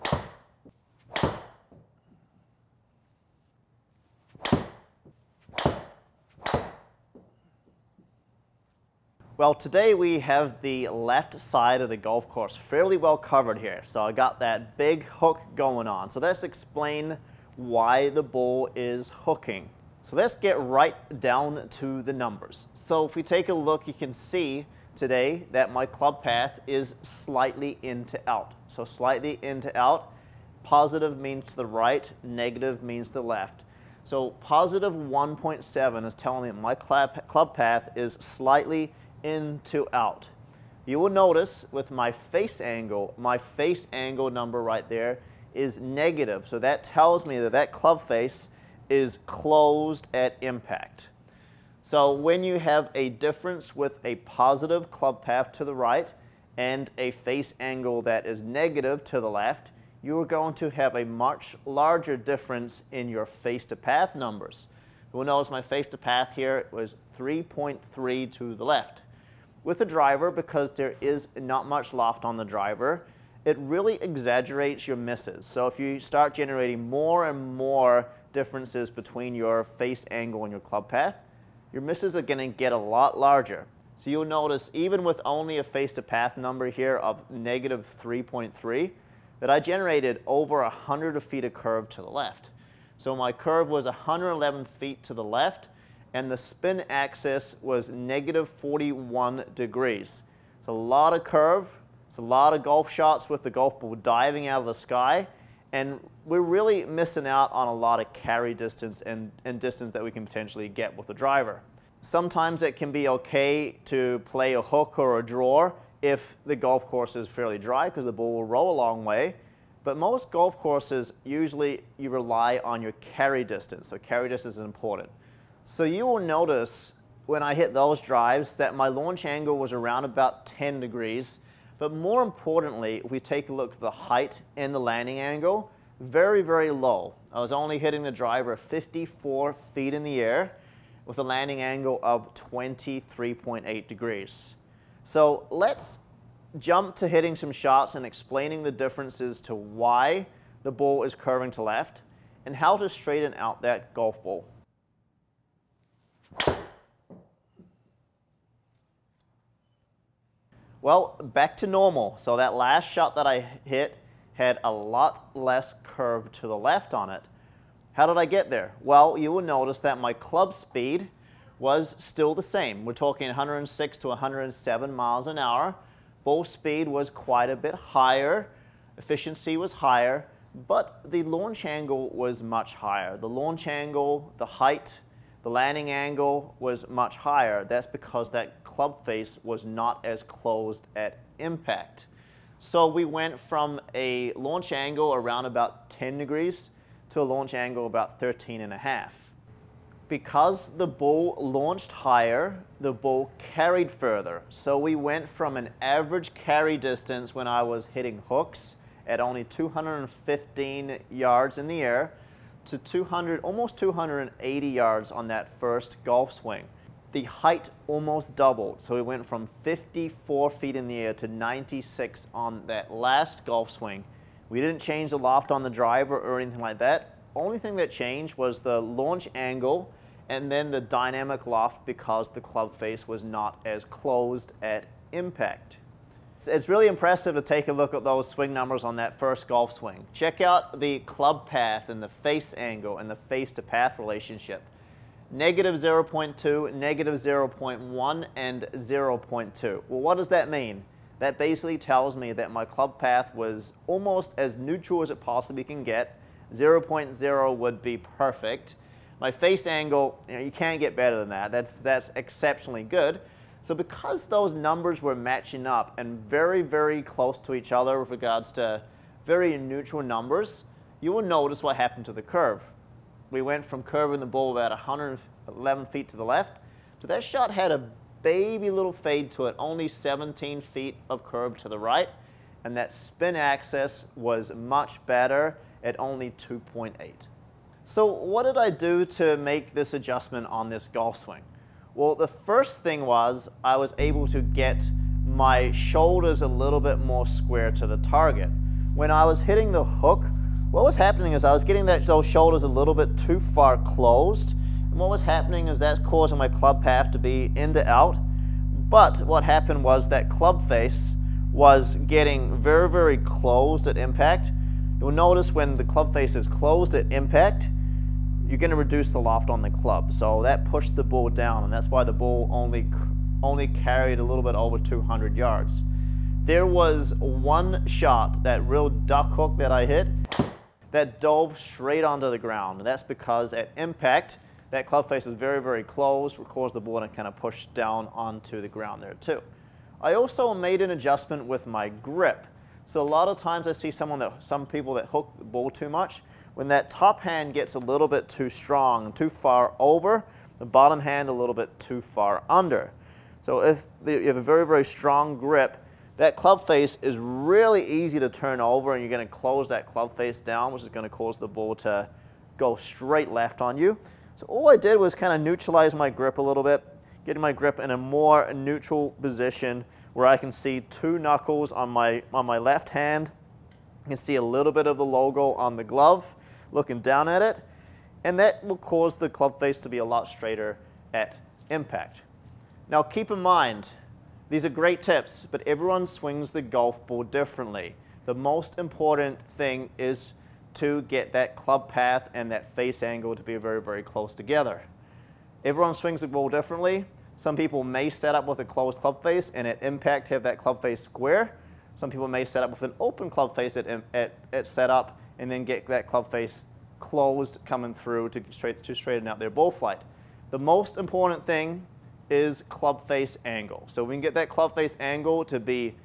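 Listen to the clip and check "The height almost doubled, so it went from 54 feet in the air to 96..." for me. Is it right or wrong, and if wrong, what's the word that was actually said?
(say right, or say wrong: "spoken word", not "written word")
right.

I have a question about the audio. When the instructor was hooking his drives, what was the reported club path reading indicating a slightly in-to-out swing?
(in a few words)
1.7.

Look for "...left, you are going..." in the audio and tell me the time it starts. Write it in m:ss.
0:59.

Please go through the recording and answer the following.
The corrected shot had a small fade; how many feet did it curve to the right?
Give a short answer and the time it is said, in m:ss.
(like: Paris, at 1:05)
17 feet, at 4:39.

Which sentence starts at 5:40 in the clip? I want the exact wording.
I also made an adjustment with my grip.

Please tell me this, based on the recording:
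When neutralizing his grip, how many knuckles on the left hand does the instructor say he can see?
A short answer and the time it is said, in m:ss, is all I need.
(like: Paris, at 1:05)
2, at 6:10.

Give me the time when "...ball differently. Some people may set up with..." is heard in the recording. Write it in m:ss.
6:36.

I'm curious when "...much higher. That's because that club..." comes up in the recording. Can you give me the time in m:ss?
3:06.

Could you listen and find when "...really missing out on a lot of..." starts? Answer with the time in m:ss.
1:46.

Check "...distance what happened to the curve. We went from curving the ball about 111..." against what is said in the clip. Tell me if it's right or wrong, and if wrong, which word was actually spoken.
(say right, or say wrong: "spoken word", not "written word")
wrong: "notice", not "distance".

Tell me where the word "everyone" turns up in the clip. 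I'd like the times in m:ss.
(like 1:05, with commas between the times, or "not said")
6:25, 6:35.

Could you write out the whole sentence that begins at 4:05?
Negative 0.2, negative 0.1, and 0.2.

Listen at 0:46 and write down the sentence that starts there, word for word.
So that tells me that that club face is closed at impact.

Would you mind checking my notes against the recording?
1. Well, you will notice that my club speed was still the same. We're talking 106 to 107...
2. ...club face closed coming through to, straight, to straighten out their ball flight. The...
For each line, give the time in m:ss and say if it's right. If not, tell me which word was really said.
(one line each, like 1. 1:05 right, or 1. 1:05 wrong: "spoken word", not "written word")
1. 2:48 right
2. 6:46 right.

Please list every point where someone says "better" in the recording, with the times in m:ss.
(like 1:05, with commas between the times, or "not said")
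4:20, 4:45.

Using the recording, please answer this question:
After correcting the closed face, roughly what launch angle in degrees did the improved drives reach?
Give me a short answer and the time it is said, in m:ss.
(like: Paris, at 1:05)
13.5, at 3:18.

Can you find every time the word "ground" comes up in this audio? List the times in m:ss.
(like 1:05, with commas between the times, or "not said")
5:32, 5:38.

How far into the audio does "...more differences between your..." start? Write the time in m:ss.
1:17.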